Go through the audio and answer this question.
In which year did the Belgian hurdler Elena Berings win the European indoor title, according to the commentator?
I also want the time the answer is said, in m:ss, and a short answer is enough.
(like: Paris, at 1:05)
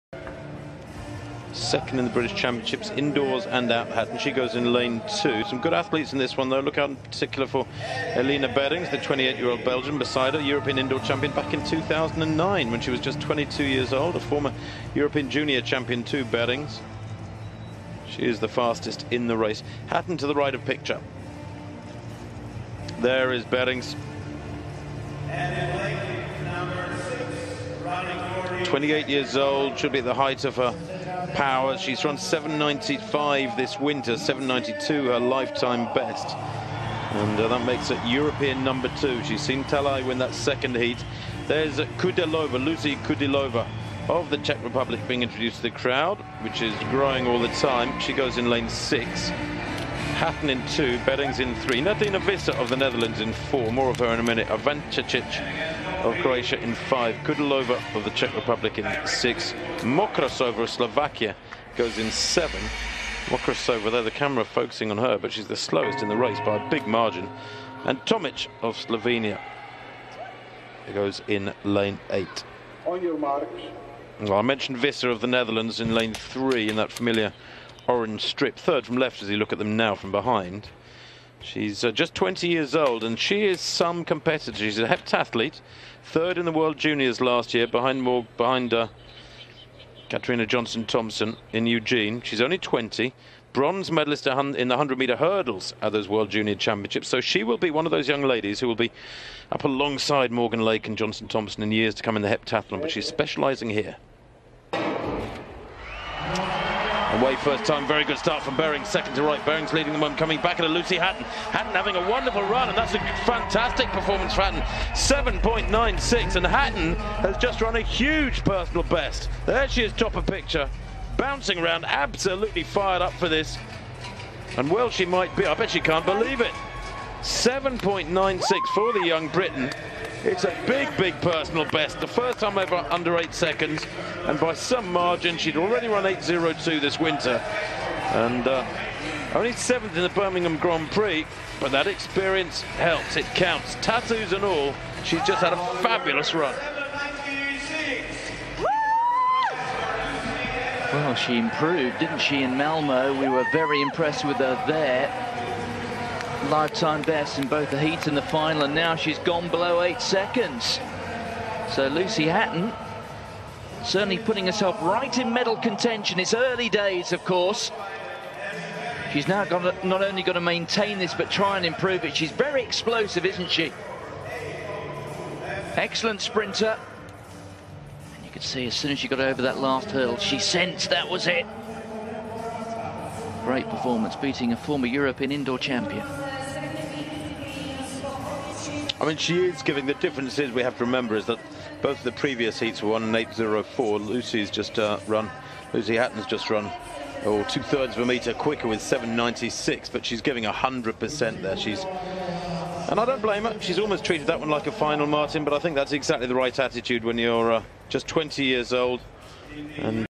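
2009, at 0:11.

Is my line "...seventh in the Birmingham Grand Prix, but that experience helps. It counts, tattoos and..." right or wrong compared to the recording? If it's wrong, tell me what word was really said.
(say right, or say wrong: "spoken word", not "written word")
right.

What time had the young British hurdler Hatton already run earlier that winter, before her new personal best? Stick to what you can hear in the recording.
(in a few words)
8.02.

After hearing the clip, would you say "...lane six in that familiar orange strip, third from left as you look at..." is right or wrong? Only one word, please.
wrong.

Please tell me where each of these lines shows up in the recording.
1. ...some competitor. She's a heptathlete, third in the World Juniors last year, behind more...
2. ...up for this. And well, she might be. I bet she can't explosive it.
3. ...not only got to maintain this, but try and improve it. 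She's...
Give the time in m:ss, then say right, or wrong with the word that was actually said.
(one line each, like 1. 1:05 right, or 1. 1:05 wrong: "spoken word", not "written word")
1. 1:23 right
2. 2:03 wrong: "believe", not "explosive"
3. 2:49 right.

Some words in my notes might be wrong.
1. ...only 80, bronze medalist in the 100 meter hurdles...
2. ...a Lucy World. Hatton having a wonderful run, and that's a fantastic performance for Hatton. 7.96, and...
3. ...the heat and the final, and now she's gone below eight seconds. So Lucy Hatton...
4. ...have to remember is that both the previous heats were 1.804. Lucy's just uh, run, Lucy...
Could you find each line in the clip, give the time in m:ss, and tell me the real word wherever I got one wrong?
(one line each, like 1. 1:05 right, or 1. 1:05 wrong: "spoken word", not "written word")
1. 1:32 wrong: "20", not "80"
2. 1:50 wrong: "Hatton", not "World"
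3. 2:37 right
4. 3:10 right.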